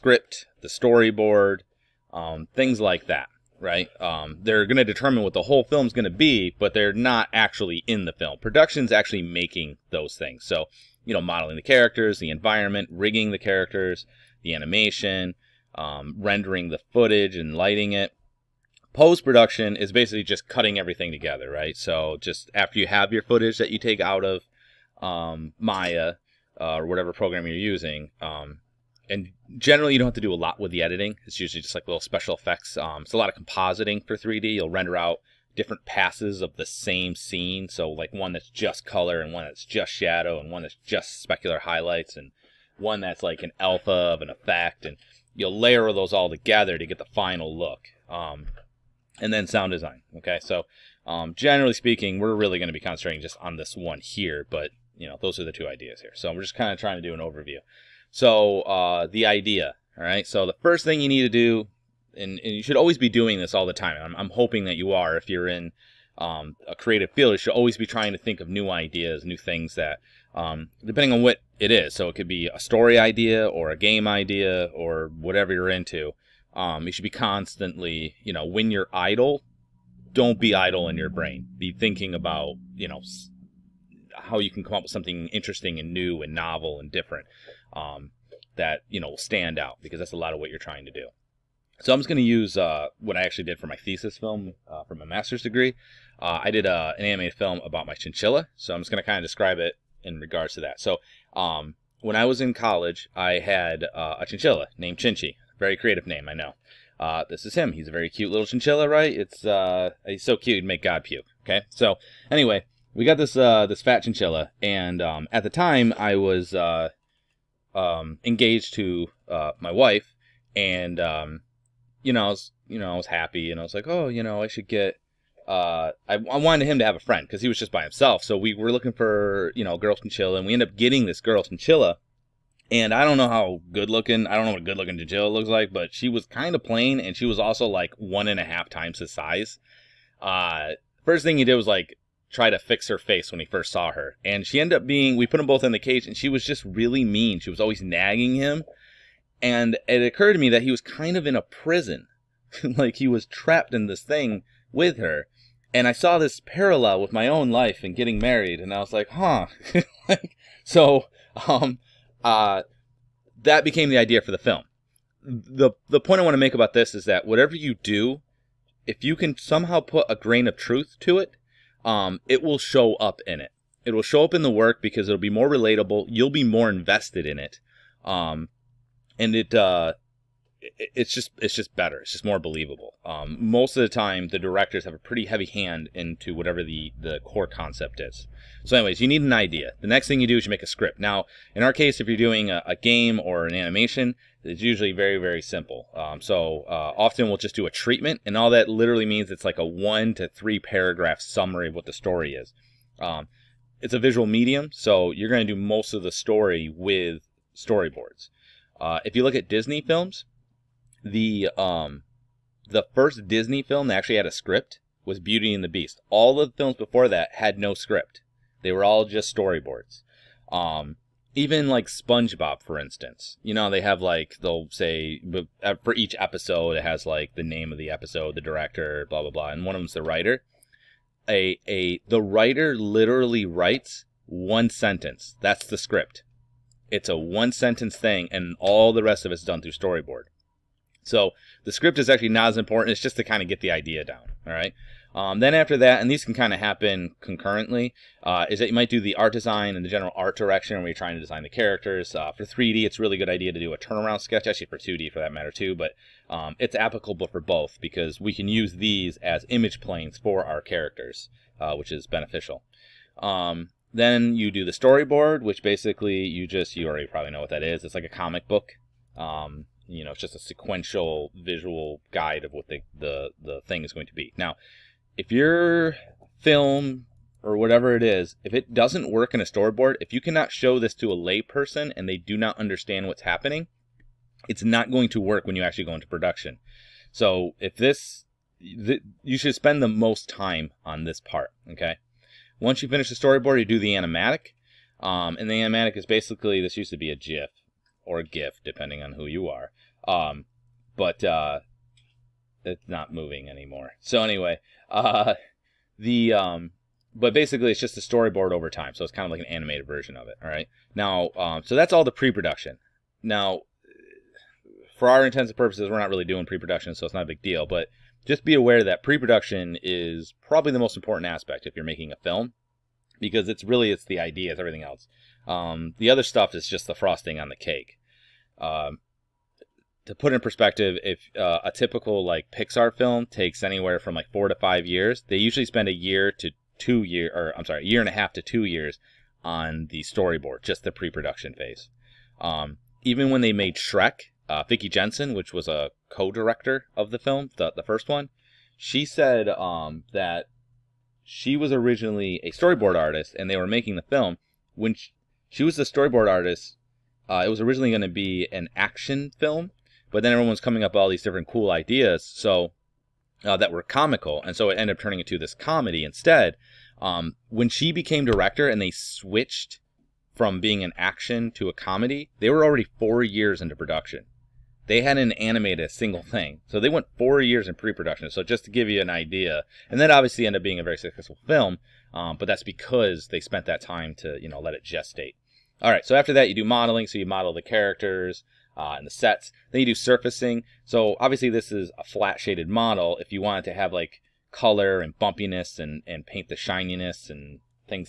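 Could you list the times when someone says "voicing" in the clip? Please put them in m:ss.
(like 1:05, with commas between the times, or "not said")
not said.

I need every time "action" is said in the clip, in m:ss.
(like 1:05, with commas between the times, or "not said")
5:58, 6:10.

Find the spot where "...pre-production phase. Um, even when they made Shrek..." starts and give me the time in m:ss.
5:40.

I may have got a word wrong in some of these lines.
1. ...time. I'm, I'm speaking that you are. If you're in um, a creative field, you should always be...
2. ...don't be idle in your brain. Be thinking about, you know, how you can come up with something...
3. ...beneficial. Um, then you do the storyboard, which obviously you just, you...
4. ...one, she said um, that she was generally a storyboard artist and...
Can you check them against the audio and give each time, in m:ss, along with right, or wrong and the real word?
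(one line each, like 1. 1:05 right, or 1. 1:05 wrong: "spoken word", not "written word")
1. 1:03 wrong: "hoping", not "speaking"
2. 1:20 right
3. 4:22 wrong: "basically", not "obviously"
4. 5:48 wrong: "originally", not "generally".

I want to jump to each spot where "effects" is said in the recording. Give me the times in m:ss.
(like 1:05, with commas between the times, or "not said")
0:32, 0:44.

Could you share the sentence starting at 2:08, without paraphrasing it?
So we were looking for you know girl chinchilla, and we end up getting this girl chinchilla.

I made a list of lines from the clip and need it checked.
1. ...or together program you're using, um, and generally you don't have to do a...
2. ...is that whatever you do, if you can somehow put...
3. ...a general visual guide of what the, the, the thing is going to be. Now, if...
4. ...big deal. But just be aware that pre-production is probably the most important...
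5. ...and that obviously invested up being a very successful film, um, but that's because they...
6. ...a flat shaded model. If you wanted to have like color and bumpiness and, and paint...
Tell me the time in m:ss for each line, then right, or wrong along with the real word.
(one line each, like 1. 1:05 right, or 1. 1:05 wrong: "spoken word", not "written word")
1. 0:26 wrong: "whatever", not "together"
2. 2:46 right
3. 4:30 wrong: "sequential", not "general"
4. 5:17 right
5. 6:19 wrong: "ended", not "invested"
6. 6:31 right.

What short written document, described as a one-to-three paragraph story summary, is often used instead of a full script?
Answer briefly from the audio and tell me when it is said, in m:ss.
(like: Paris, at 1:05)
A treatment, at 3:17.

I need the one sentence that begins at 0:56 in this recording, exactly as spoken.
So we're just kind of trying to do an overview.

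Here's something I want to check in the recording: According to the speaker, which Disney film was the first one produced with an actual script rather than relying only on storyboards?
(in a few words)
Beauty and the Beast.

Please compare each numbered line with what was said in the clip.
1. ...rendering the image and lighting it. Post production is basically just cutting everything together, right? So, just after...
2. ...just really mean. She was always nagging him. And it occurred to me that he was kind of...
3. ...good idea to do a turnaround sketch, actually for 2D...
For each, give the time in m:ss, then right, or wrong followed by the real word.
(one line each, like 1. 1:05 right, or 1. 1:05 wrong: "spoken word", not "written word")
1. 0:16 wrong: "footage", not "image"
2. 2:26 right
3. 4:13 right.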